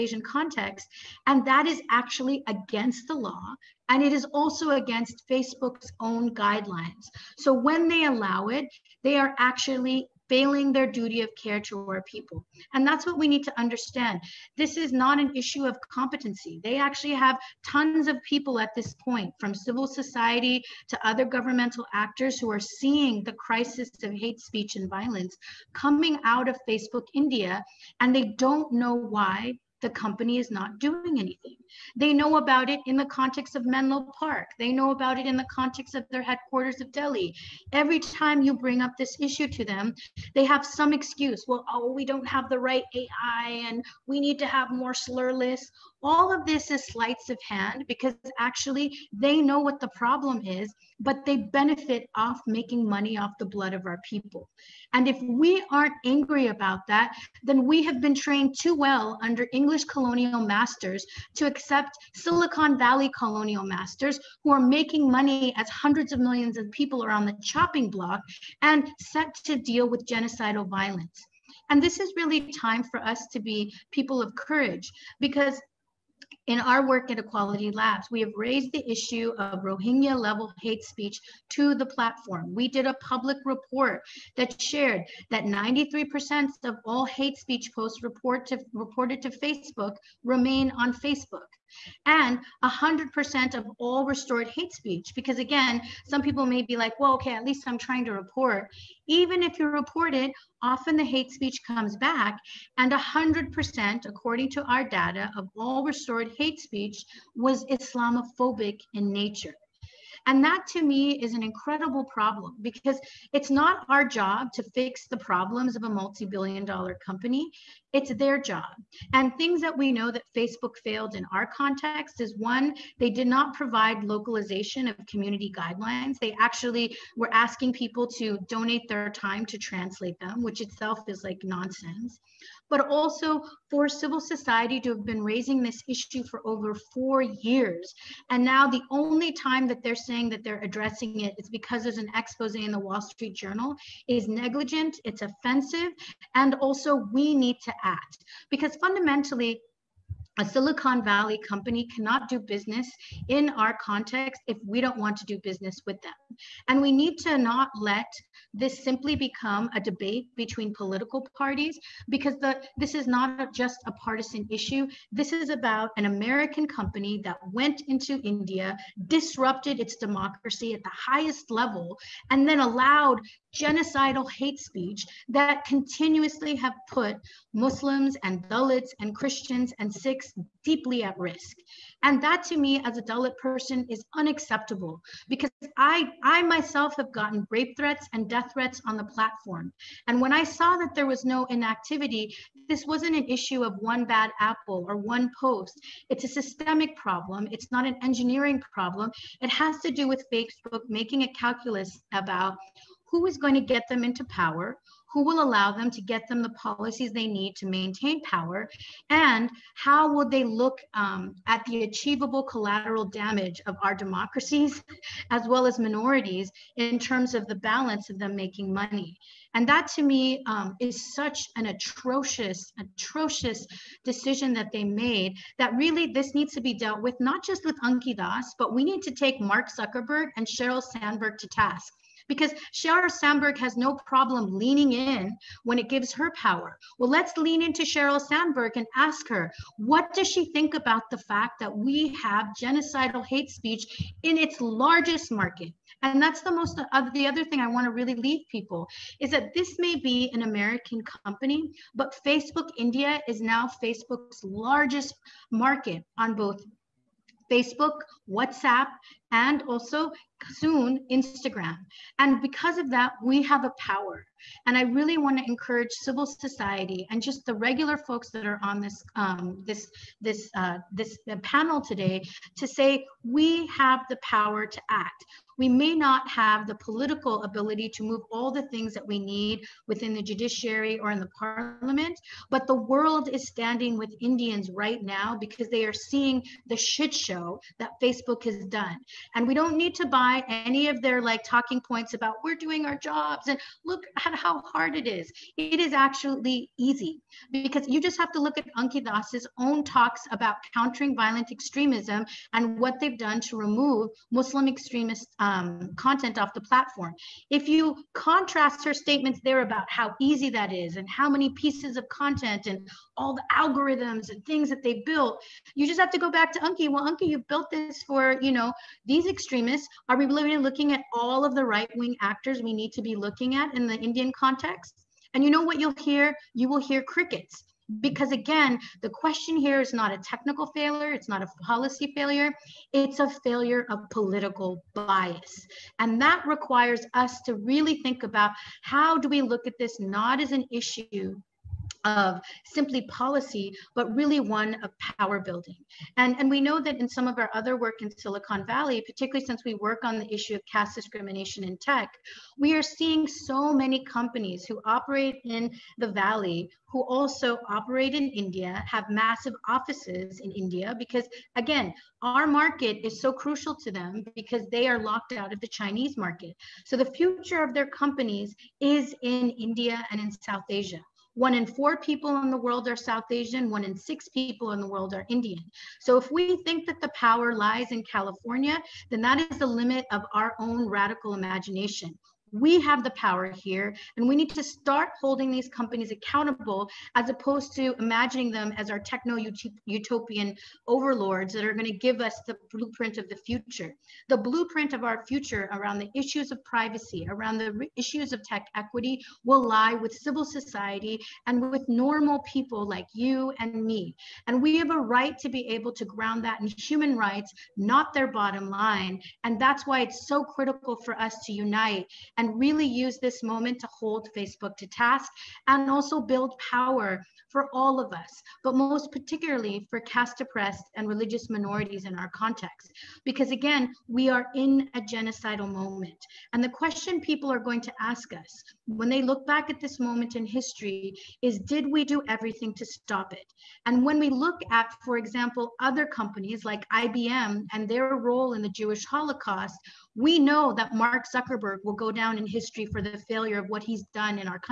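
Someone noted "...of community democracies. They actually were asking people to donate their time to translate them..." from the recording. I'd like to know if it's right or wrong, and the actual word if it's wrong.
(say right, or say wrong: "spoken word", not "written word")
wrong: "guidelines", not "democracies".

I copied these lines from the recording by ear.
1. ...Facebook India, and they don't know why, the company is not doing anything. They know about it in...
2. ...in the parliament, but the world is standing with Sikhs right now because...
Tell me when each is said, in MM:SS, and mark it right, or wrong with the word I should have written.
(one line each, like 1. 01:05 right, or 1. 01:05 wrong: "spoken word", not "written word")
1. 00:26 right
2. 04:41 wrong: "Indians", not "Sikhs".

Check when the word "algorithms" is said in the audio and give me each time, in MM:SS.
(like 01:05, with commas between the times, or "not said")
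05:13.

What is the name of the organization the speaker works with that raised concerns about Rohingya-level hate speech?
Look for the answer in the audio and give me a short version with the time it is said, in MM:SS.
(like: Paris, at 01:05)
Equality Labs, at 01:17.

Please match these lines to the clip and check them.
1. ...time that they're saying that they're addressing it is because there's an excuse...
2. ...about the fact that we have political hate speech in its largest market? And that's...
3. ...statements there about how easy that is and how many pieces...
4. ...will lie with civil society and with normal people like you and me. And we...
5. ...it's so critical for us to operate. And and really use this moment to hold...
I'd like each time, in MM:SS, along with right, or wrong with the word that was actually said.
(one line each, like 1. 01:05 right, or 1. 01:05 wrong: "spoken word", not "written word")
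1. 02:19 wrong: "expose", not "excuse"
2. 04:00 wrong: "genocidal", not "political"
3. 05:08 right
4. 06:39 right
5. 06:50 wrong: "unite", not "operate".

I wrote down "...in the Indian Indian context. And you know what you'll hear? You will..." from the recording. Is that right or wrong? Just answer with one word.
right.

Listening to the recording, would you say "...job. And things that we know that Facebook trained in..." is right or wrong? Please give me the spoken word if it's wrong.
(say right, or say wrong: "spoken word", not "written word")
wrong: "failed", not "trained".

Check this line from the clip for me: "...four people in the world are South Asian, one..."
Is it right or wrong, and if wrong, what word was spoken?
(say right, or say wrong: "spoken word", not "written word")
right.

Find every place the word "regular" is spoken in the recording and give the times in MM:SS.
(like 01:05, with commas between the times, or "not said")
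04:27.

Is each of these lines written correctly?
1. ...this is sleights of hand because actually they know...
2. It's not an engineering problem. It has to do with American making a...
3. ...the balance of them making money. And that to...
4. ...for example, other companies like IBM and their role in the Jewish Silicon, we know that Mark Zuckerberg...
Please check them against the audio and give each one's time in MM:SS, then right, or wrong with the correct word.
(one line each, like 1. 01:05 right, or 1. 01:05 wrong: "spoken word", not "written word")
1. 00:46 right
2. 03:17 wrong: "Facebook", not "American"
3. 03:37 right
4. 07:15 wrong: "Holocaust", not "Silicon".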